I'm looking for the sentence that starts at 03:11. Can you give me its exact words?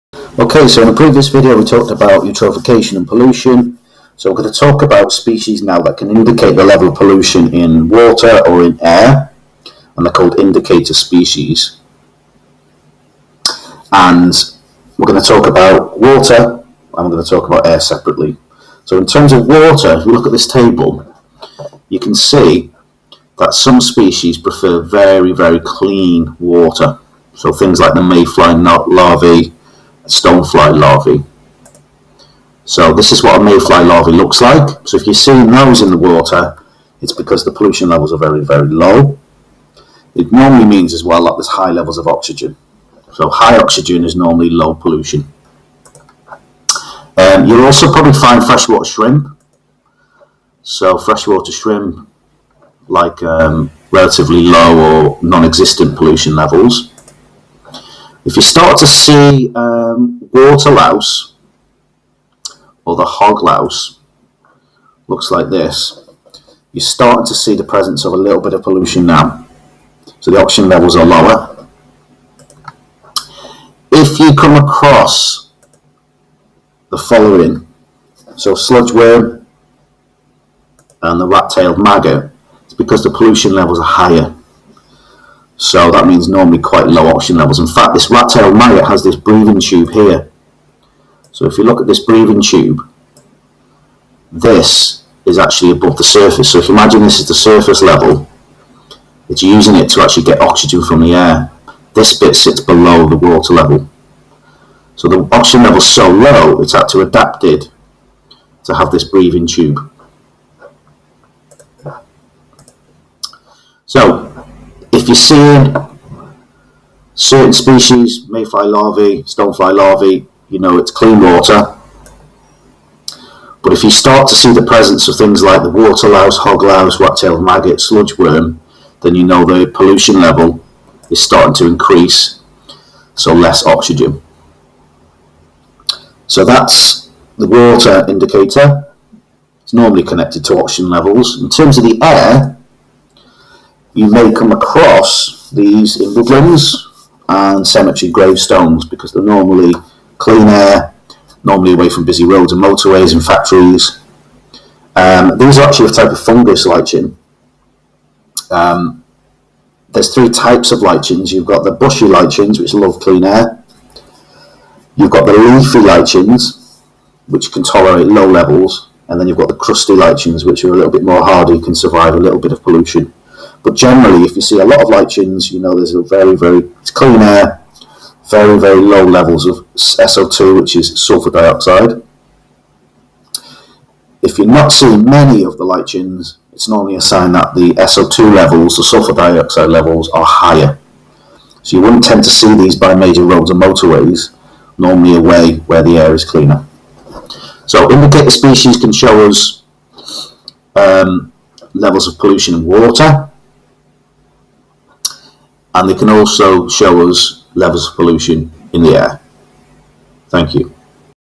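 So you wouldn't tend to see these by major roads and motorways, normally a way where the air is cleaner.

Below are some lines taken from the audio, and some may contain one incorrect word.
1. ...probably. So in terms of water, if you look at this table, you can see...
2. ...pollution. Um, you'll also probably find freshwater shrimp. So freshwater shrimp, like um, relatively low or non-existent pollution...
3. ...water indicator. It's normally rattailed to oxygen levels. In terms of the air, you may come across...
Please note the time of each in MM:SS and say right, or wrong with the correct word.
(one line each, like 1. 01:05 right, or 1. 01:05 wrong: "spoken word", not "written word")
1. 00:17 wrong: "separately", not "probably"
2. 00:44 right
3. 02:17 wrong: "connected", not "rattailed".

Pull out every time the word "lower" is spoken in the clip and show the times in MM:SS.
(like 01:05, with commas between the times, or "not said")
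01:11.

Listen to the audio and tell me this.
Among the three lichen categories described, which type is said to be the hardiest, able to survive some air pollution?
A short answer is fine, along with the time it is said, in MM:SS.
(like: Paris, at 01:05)
Crusty lichens, at 02:49.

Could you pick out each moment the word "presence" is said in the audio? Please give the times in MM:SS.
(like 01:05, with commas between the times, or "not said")
01:07, 02:04.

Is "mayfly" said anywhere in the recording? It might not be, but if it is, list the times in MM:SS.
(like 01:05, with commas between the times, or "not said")
00:28, 00:33, 01:58.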